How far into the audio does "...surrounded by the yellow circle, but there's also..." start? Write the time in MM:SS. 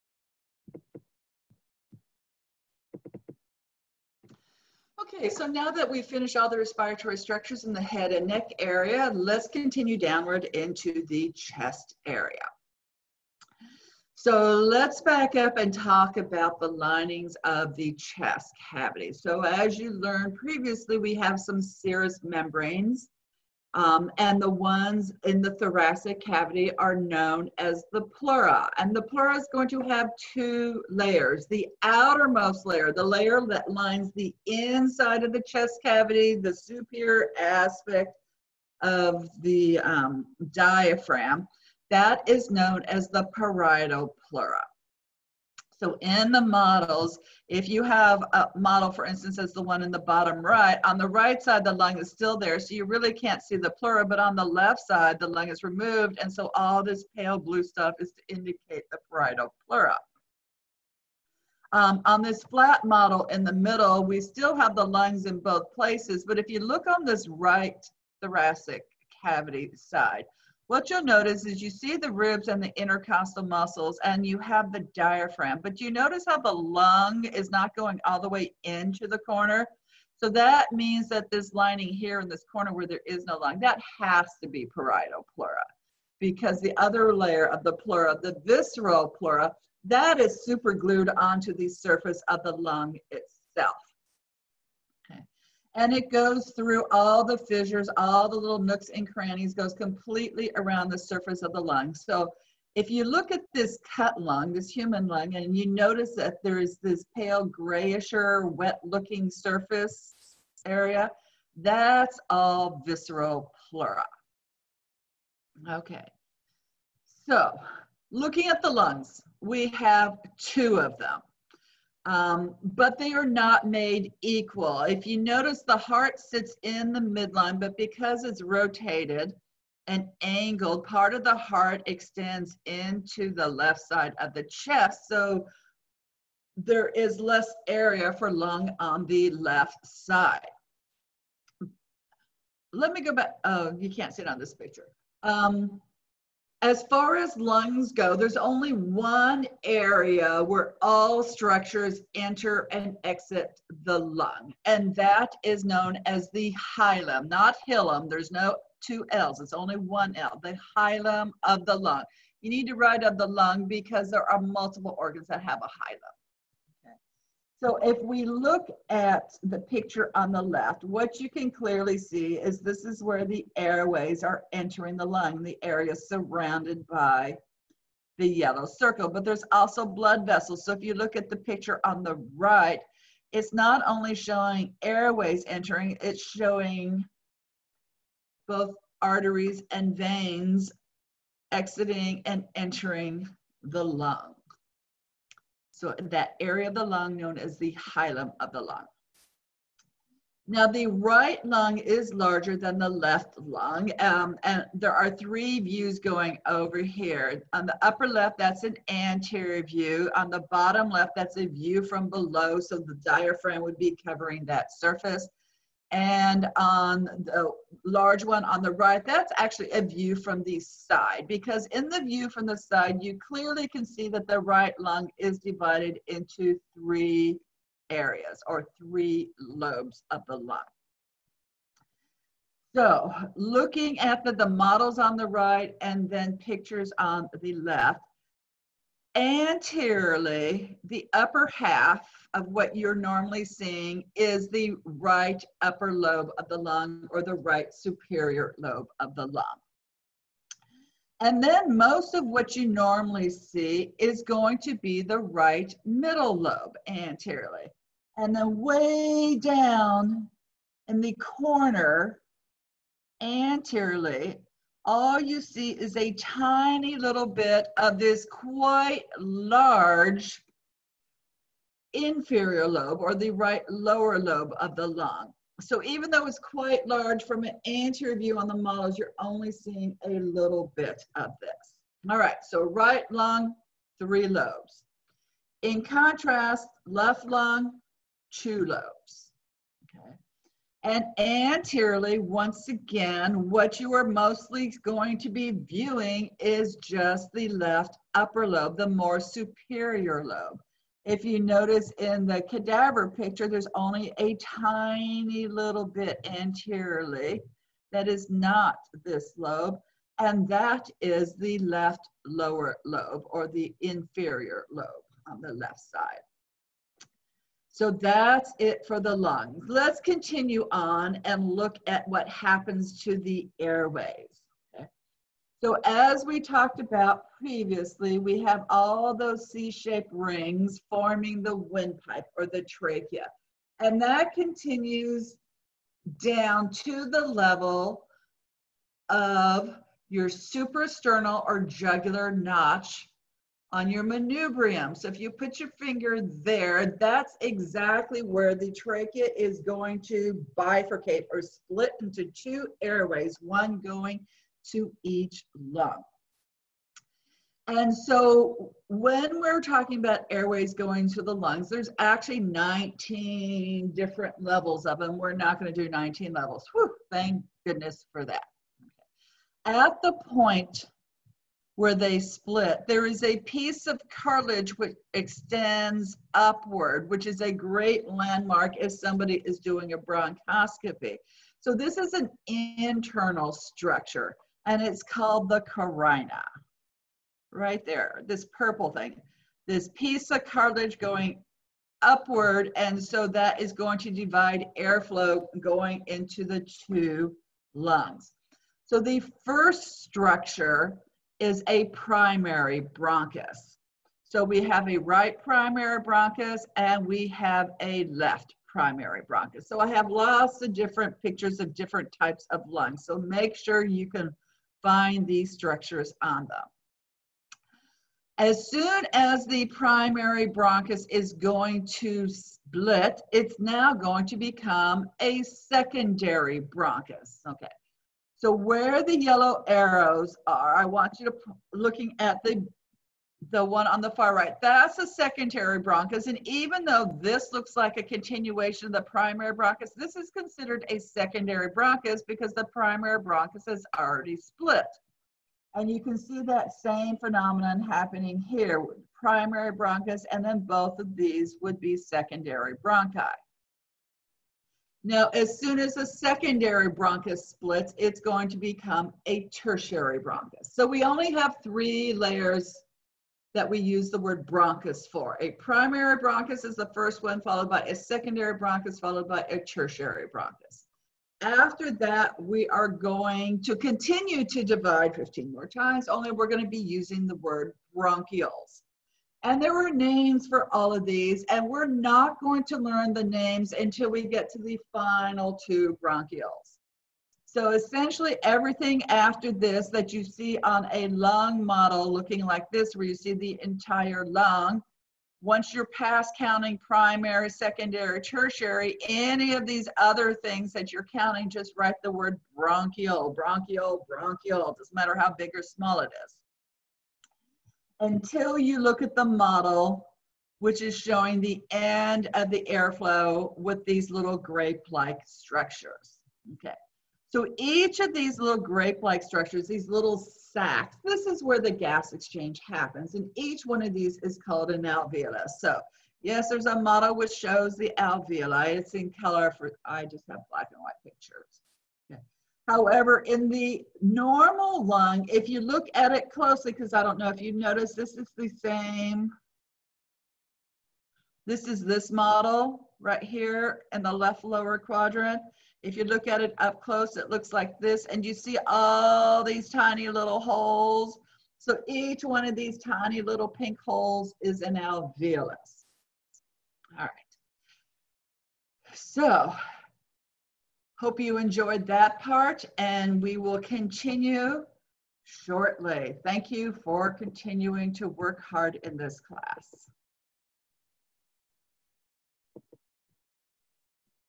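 02:55.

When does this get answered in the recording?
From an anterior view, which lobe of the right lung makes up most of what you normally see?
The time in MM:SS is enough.
04:15.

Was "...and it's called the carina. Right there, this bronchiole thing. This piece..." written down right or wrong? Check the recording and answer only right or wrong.
wrong.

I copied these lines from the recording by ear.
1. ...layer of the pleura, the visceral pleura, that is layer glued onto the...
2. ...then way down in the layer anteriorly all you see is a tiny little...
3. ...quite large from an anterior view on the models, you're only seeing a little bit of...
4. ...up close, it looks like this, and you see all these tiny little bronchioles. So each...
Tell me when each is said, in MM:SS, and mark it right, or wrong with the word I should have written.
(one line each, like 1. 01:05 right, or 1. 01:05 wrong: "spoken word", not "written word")
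1. 01:27 wrong: "super", not "layer"
2. 04:18 wrong: "corner", not "layer"
3. 04:36 right
4. 09:06 wrong: "holes", not "bronchioles".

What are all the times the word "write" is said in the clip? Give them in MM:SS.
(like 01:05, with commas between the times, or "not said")
02:42, 08:21.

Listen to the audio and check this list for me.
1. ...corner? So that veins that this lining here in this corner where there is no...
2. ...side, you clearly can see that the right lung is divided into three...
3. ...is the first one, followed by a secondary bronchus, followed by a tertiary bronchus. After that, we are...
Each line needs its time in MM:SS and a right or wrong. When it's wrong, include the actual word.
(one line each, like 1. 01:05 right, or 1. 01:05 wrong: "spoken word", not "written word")
1. 01:19 wrong: "means", not "veins"
2. 03:42 right
3. 07:46 right.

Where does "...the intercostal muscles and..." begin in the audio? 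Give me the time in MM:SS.
01:12.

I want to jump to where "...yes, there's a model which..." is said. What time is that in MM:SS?
08:46.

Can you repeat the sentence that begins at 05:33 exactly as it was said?
And that continues down to the level of your suprasternal or jugular notch on your manubrium.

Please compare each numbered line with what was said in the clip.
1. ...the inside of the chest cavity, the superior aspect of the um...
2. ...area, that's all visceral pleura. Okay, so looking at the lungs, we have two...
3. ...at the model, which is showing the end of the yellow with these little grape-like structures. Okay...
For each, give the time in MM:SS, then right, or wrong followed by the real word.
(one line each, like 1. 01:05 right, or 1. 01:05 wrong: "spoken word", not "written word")
1. 00:34 right
2. 01:50 right
3. 08:29 wrong: "airflow", not "yellow".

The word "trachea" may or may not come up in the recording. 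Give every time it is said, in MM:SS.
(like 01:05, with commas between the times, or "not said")
05:32, 05:48.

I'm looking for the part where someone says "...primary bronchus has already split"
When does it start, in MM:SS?
07:22.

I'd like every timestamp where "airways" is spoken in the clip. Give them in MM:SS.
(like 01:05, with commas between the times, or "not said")
02:53, 03:04, 05:23, 05:52, 06:00.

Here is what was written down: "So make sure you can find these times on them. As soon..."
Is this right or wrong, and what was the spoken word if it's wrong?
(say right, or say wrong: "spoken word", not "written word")
wrong: "structures", not "times".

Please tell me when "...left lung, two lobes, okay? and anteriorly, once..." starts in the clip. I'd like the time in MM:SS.
04:46.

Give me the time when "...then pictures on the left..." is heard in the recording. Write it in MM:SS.
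03:56.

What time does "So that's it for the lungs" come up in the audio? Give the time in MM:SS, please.
05:17.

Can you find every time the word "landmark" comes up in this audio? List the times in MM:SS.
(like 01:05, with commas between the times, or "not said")
06:18.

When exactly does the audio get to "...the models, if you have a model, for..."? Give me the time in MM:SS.
00:46.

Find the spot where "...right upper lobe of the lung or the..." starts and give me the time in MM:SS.
04:04.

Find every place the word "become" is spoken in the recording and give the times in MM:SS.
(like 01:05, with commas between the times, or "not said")
07:04, 07:38.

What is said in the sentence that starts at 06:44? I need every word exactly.
So we have a right primary bronchus and we have a left primary bronchus.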